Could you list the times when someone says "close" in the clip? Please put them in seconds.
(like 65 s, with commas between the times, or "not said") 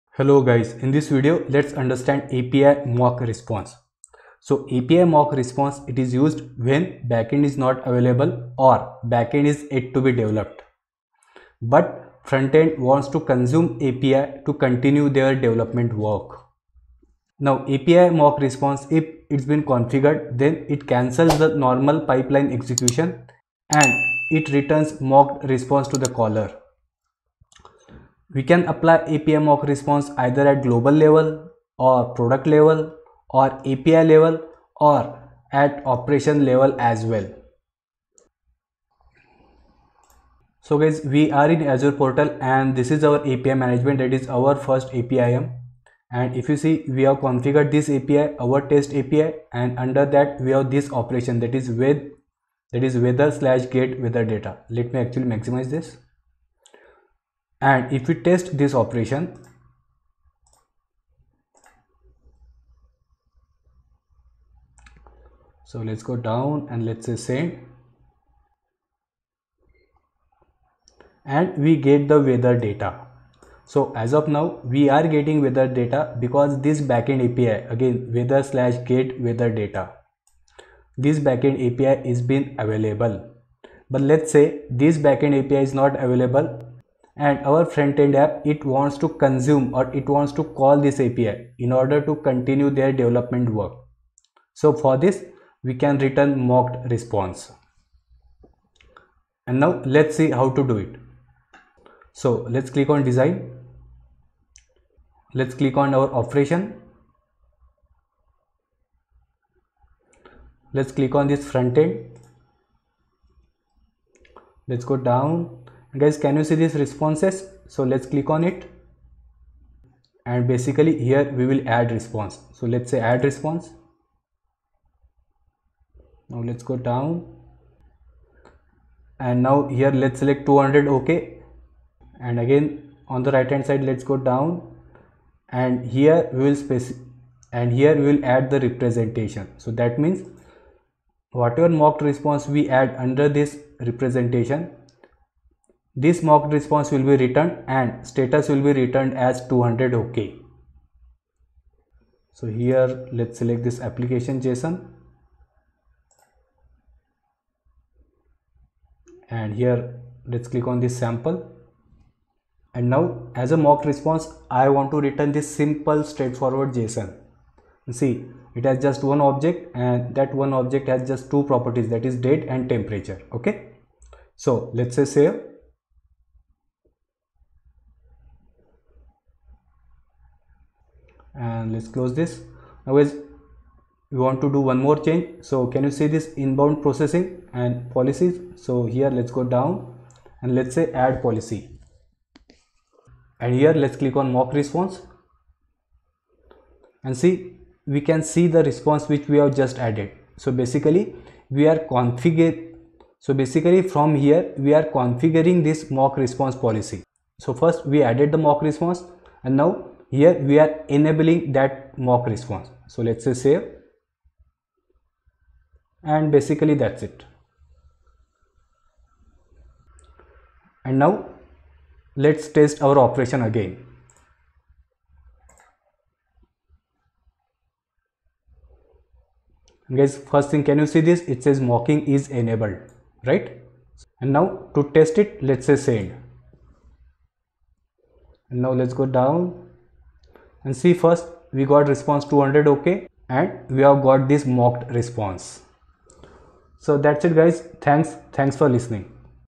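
181 s.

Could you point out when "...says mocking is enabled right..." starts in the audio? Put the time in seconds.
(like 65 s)
231 s.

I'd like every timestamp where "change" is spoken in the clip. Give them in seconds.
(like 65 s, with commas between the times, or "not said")
184 s.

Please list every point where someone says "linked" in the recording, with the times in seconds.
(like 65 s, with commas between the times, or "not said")
not said.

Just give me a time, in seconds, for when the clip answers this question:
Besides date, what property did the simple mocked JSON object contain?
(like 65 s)
172 s.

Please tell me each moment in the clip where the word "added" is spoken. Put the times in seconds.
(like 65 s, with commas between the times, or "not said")
199 s, 208 s.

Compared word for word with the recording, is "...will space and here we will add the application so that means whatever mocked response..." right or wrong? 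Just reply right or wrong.
wrong.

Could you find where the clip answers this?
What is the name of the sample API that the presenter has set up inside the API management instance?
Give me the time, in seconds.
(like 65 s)
48 s.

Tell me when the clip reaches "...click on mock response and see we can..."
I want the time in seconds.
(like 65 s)
193 s.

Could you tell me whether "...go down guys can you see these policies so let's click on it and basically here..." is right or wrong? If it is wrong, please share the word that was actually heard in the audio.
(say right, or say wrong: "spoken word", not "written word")
wrong: "responses", not "policies".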